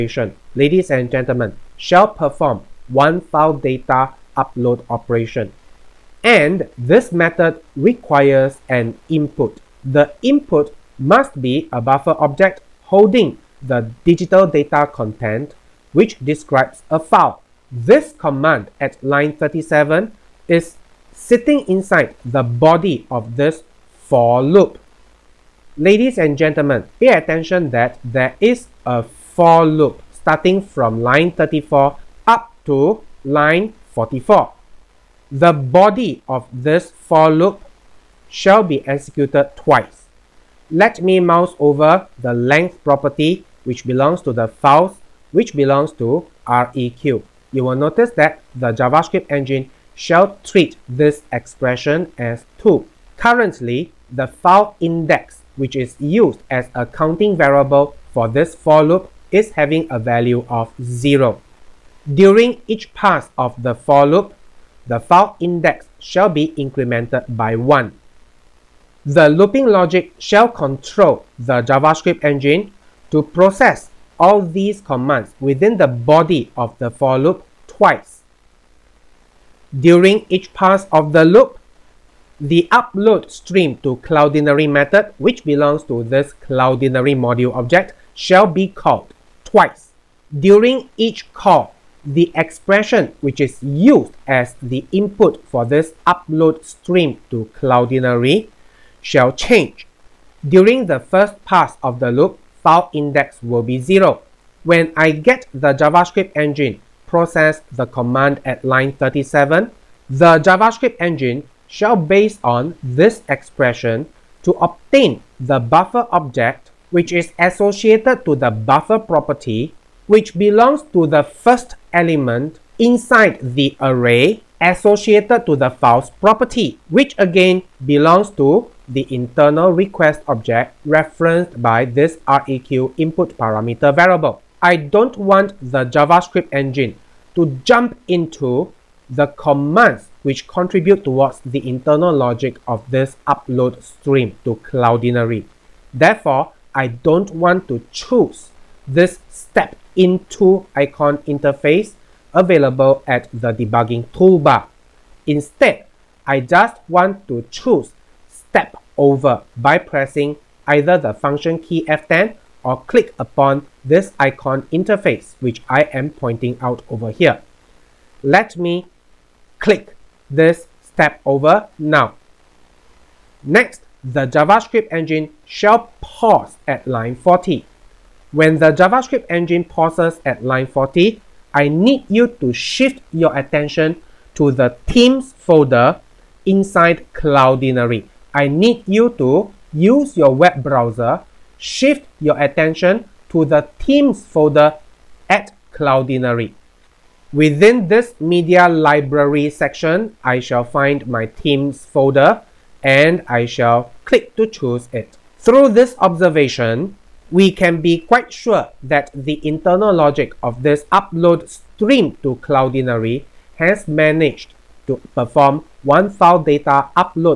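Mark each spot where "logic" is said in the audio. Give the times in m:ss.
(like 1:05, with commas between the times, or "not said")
1:09, 2:22, 3:29.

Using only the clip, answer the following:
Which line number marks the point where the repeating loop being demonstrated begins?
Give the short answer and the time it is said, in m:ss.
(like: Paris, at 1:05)
34, at 0:31.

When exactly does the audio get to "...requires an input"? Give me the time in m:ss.
0:07.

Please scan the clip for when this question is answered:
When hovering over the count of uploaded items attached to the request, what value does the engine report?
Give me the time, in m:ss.
0:52.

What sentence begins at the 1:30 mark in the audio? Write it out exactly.
During each call, the expression which is used as the input for this upload stream to Cloudinary shall change.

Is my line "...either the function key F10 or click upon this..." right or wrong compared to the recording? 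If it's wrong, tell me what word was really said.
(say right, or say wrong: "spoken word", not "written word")
right.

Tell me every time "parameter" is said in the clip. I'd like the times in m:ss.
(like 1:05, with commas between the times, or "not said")
2:13.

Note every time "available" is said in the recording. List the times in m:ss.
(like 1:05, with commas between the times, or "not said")
2:32.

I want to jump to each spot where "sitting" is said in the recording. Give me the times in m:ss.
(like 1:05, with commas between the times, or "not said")
0:21.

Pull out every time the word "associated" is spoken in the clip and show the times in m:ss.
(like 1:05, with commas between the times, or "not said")
1:57, 2:04.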